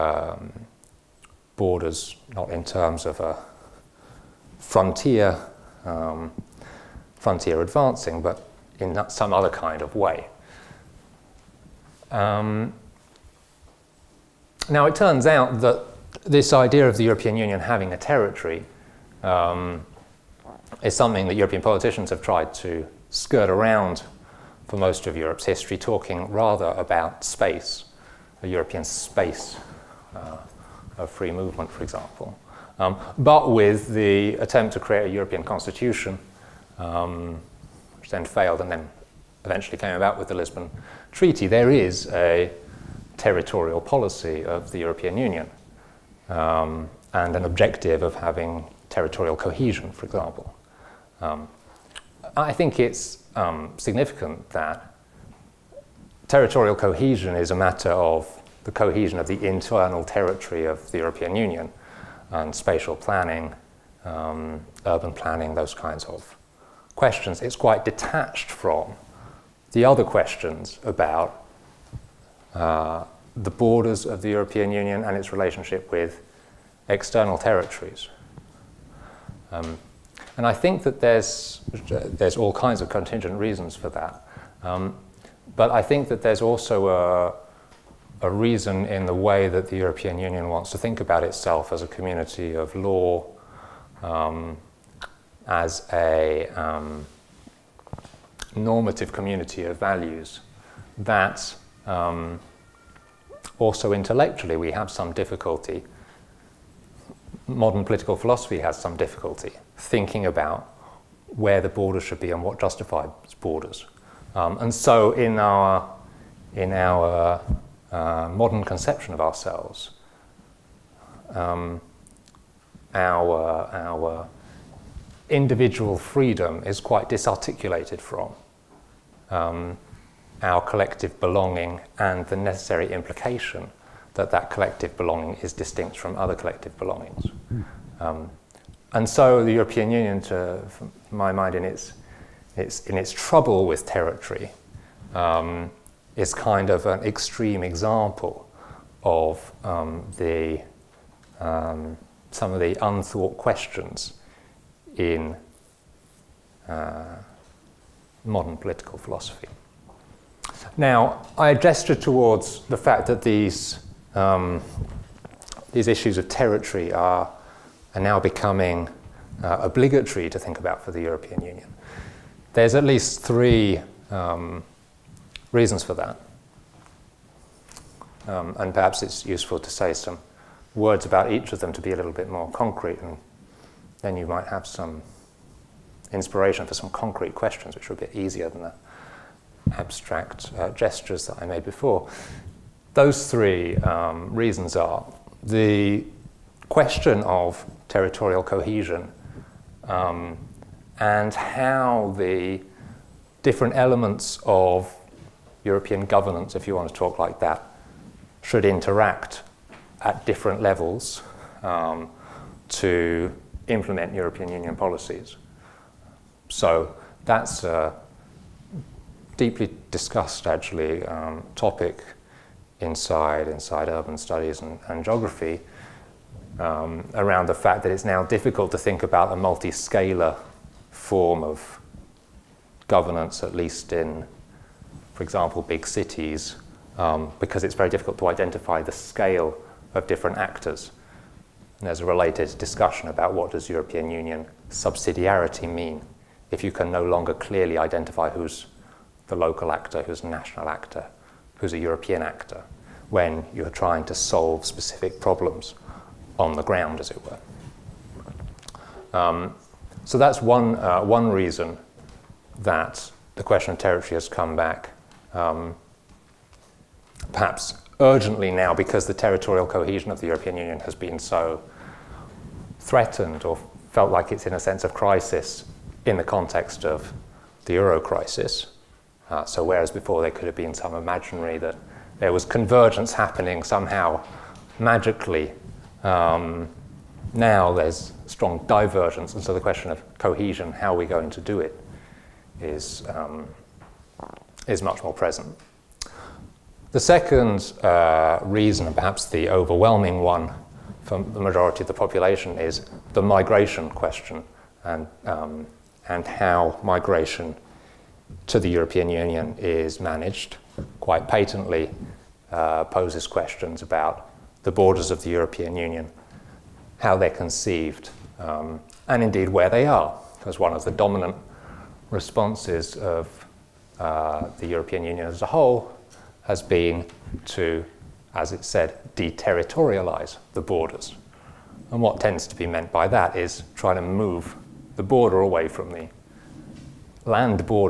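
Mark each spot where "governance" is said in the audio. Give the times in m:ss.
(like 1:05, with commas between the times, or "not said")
3:26, 3:52.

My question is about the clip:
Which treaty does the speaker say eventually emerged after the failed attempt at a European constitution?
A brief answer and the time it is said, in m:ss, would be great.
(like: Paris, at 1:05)
Lisbon Treaty, at 0:40.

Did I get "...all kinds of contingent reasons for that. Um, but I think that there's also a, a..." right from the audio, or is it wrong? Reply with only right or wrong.
right.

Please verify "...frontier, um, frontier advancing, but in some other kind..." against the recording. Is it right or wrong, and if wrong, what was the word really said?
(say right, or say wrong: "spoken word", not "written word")
right.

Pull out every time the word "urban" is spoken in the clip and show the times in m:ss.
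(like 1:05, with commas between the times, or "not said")
1:04, 3:43.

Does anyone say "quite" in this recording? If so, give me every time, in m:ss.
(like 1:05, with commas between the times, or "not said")
1:07, 2:06, 5:10.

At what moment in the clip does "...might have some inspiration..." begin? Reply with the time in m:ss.
3:04.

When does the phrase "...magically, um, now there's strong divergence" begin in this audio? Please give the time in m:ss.
4:44.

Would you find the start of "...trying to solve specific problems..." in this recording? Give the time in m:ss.
4:13.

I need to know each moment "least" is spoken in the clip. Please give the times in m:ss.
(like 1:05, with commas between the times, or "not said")
2:52, 3:53.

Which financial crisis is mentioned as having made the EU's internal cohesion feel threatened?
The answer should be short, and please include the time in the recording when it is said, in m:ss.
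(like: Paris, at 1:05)
the euro crisis, at 4:37.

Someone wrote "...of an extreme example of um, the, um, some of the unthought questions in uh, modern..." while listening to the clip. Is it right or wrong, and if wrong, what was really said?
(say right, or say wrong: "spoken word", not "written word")
right.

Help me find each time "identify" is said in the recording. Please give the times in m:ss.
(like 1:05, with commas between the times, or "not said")
3:58, 4:07.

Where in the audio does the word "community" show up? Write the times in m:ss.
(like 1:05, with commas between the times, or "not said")
1:31, 1:39.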